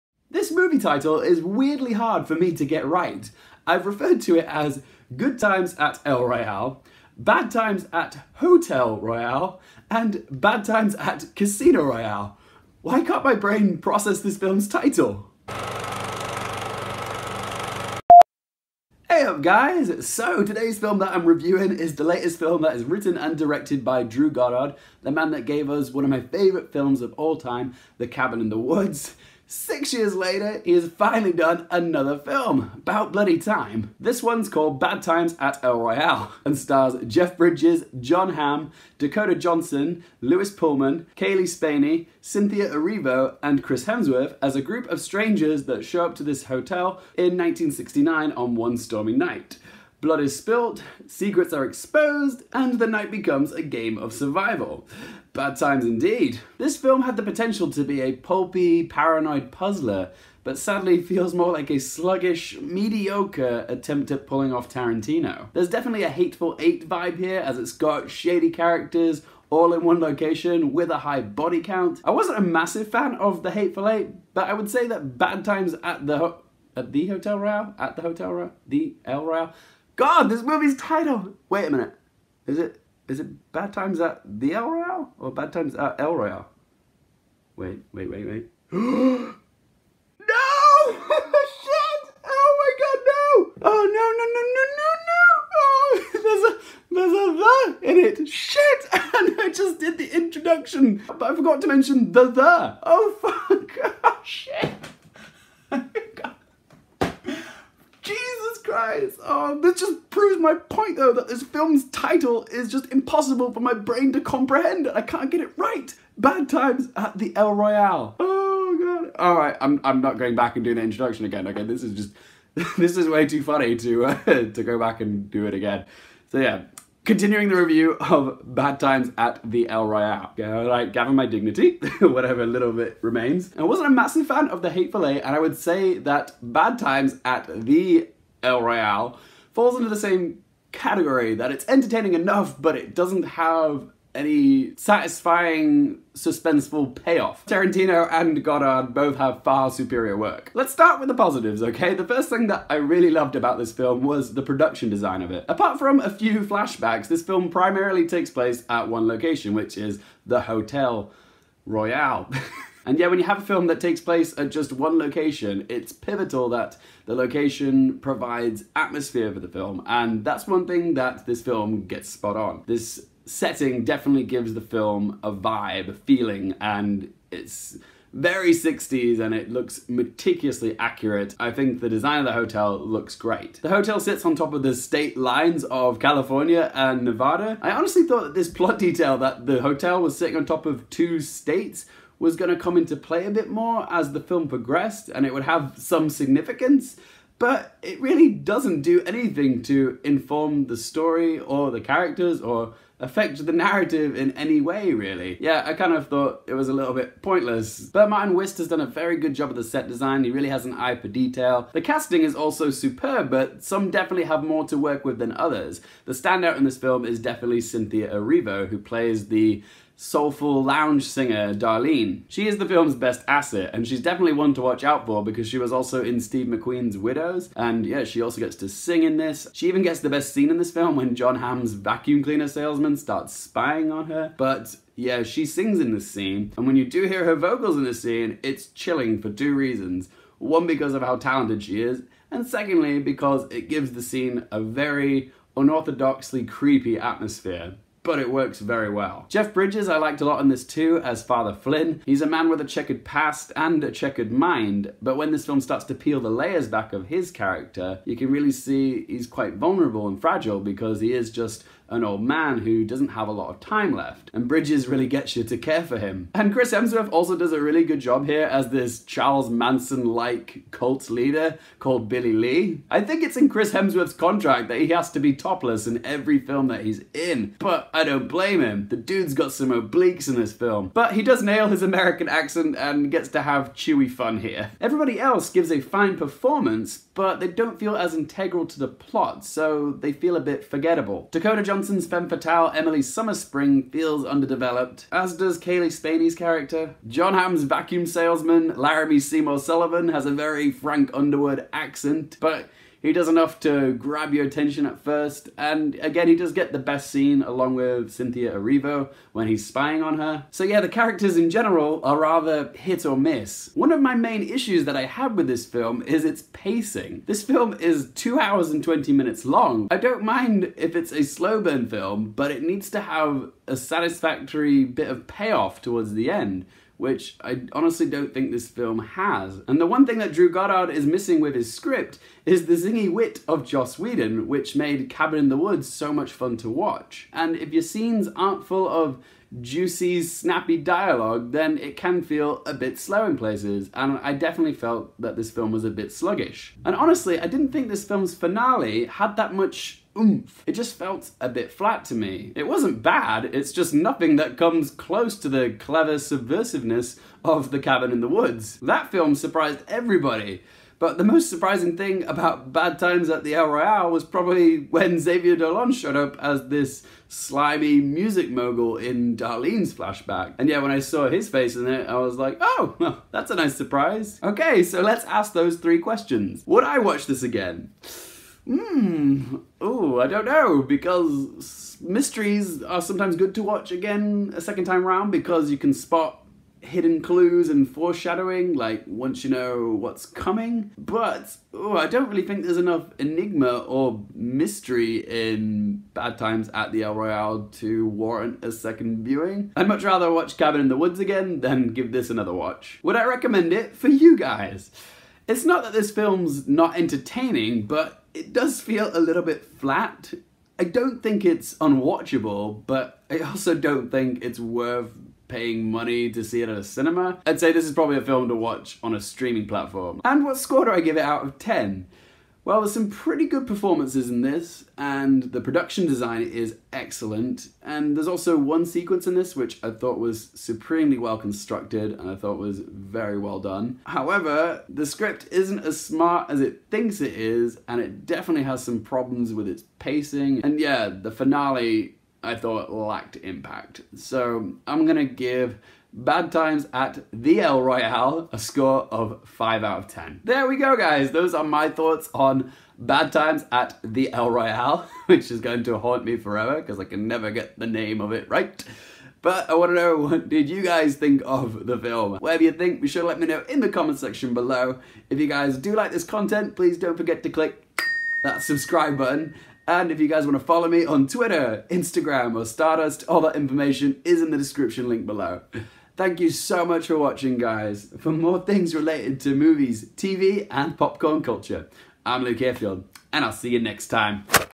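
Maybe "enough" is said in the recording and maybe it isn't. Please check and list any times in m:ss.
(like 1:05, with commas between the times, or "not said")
2:22, 5:03, 6:32.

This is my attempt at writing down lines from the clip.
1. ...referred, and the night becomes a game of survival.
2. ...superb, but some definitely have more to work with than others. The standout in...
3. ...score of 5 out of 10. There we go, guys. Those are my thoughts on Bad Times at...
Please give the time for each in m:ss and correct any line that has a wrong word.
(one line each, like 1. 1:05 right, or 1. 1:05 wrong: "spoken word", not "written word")
1. 0:51 wrong: "exposed", not "referred"
2. 3:32 right
3. 7:28 right.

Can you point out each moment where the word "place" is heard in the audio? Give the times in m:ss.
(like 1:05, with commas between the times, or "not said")
2:38, 2:44, 5:43.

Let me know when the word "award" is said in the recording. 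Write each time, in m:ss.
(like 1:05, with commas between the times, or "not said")
not said.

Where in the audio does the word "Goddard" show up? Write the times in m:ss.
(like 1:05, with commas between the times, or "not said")
0:24, 2:28, 5:30.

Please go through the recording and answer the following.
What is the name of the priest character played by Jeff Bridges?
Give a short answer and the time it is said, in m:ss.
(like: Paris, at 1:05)
Father Flynn, at 4:11.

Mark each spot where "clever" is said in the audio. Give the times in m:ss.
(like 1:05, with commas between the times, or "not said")
5:55.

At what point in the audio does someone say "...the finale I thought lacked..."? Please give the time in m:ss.
7:21.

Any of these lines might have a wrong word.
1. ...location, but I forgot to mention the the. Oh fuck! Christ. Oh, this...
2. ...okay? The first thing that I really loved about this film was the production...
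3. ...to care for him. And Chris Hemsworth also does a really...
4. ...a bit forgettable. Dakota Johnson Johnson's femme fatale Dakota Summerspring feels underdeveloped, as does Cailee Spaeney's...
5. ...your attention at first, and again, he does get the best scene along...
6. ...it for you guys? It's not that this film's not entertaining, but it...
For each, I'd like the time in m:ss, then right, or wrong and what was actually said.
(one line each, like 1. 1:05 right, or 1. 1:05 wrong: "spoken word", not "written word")
1. 1:40 wrong: "introduction", not "location"
2. 2:31 right
3. 4:25 right
4. 4:50 wrong: "Emily", not "Dakota"
5. 5:04 right
6. 6:43 right.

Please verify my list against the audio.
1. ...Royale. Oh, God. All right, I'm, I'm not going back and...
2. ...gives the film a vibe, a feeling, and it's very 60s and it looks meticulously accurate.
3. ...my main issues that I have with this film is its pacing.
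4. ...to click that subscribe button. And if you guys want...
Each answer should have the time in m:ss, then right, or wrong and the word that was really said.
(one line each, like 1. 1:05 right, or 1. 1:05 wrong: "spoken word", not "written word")
1. 1:57 right
2. 2:54 right
3. 5:14 right
4. 7:47 right.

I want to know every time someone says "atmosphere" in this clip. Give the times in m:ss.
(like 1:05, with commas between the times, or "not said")
2:48, 4:06.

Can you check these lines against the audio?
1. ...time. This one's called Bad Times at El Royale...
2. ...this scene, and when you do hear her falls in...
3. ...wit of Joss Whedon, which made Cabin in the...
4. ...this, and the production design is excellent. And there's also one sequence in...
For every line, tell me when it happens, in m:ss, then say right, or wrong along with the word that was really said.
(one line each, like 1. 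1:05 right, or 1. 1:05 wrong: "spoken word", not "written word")
1. 0:33 right
2. 3:55 wrong: "vocals", not "falls"
3. 5:33 right
4. 7:04 right.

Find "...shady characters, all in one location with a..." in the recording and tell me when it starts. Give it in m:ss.
1:08.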